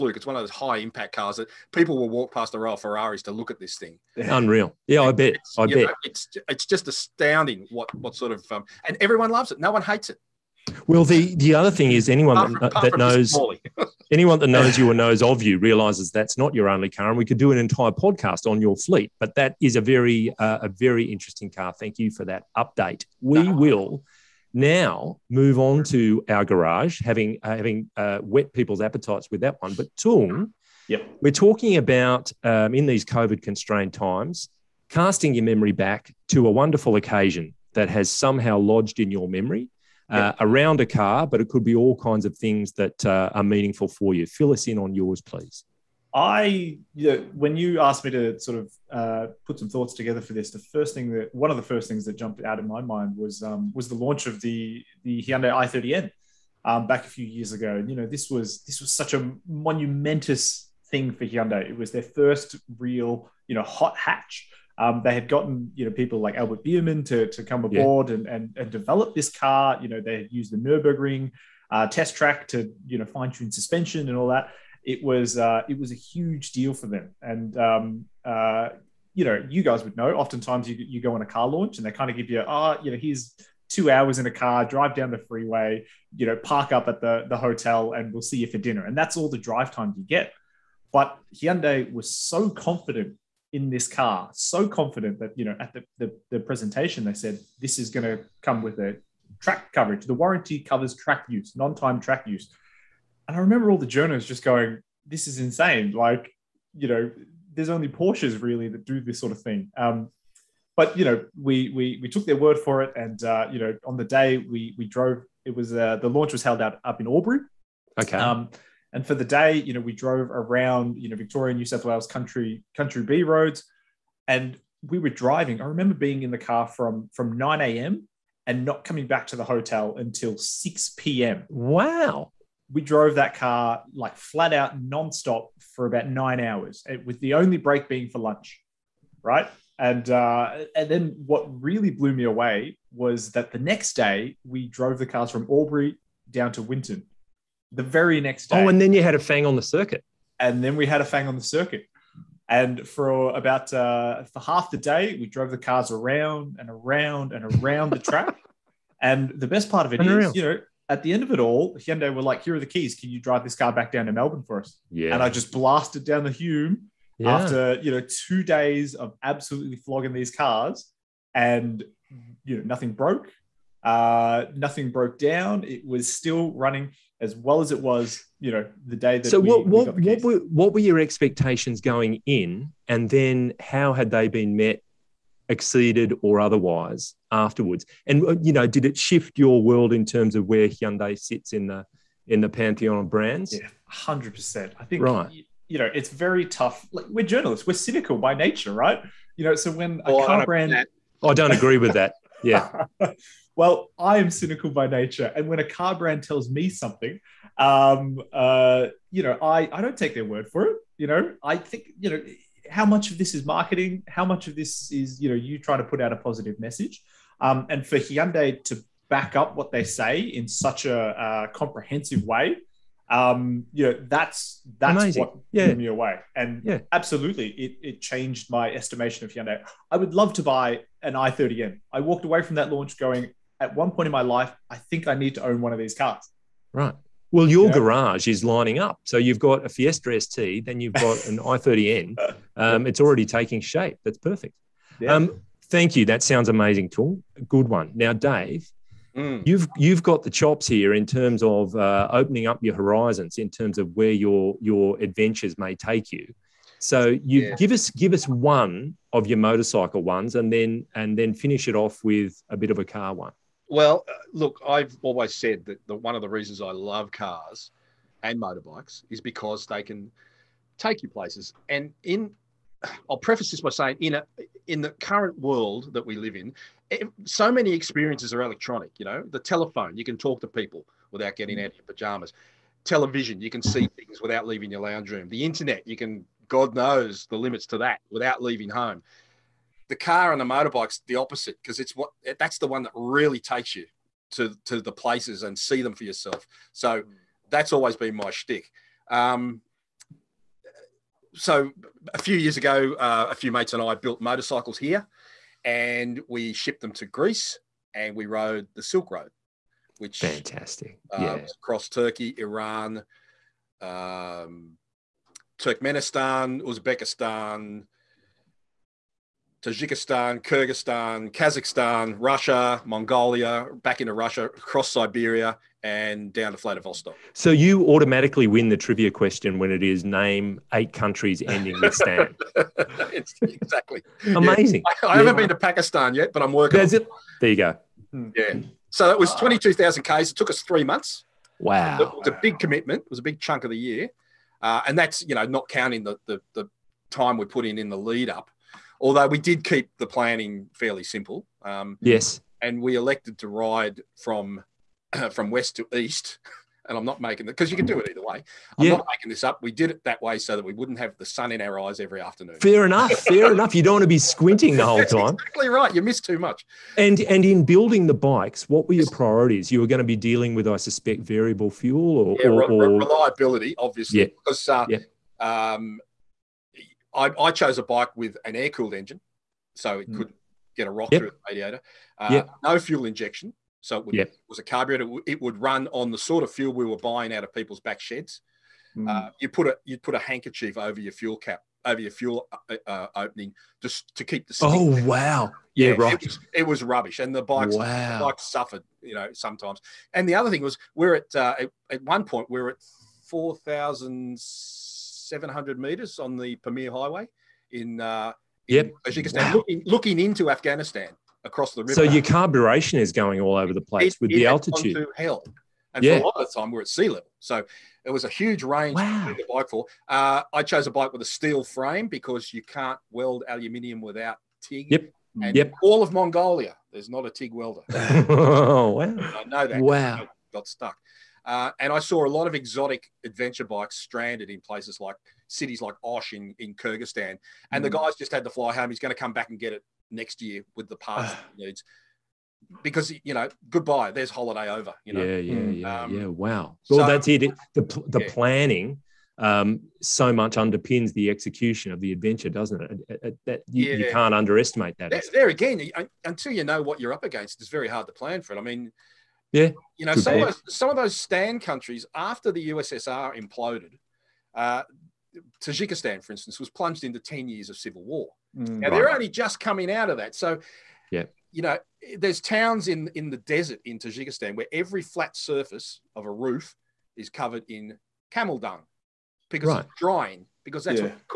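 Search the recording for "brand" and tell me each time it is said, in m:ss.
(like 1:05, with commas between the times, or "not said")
3:13, 3:20, 3:25.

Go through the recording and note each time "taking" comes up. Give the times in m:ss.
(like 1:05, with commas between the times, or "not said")
4:03.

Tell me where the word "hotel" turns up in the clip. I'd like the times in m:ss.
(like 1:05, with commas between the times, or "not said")
1:27, 2:09.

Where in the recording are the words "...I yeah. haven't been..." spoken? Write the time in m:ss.
5:35.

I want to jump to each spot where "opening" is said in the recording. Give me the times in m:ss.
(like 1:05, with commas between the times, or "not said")
4:12, 6:33.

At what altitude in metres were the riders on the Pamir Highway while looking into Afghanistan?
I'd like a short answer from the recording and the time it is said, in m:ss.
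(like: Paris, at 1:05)
4,700, at 6:43.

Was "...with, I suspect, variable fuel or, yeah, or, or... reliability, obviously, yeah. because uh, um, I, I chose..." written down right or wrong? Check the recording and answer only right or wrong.
right.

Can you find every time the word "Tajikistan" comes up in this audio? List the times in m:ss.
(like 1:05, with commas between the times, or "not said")
5:19, 6:49, 7:45, 7:53.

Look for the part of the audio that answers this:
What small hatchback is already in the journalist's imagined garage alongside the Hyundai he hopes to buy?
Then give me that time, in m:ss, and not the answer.
3:59.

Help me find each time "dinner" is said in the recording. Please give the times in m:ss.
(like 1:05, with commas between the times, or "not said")
1:28.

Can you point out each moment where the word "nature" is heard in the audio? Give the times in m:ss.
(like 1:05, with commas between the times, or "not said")
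3:18, 3:24.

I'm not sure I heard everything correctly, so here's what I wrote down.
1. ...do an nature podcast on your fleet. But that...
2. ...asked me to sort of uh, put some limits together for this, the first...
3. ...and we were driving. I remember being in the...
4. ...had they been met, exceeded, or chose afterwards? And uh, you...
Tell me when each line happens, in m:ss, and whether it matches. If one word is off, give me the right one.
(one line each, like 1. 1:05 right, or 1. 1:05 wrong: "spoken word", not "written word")
1. 0:17 wrong: "entire", not "nature"
2. 0:47 wrong: "thoughts", not "limits"
3. 2:04 right
4. 3:03 wrong: "otherwise", not "chose".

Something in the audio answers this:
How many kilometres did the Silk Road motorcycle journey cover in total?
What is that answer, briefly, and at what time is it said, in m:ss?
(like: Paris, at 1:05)
22,000, at 5:39.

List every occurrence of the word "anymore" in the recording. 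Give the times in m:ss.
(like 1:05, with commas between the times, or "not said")
not said.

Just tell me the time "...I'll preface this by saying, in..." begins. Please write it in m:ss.
4:33.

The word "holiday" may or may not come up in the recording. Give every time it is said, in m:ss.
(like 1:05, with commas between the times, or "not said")
7:24.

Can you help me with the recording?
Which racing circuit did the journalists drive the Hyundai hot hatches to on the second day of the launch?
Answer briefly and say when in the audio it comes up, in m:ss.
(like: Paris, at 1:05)
Winton, at 2:26.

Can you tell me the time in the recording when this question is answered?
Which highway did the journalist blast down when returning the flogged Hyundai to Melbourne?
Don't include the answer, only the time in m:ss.
2:46.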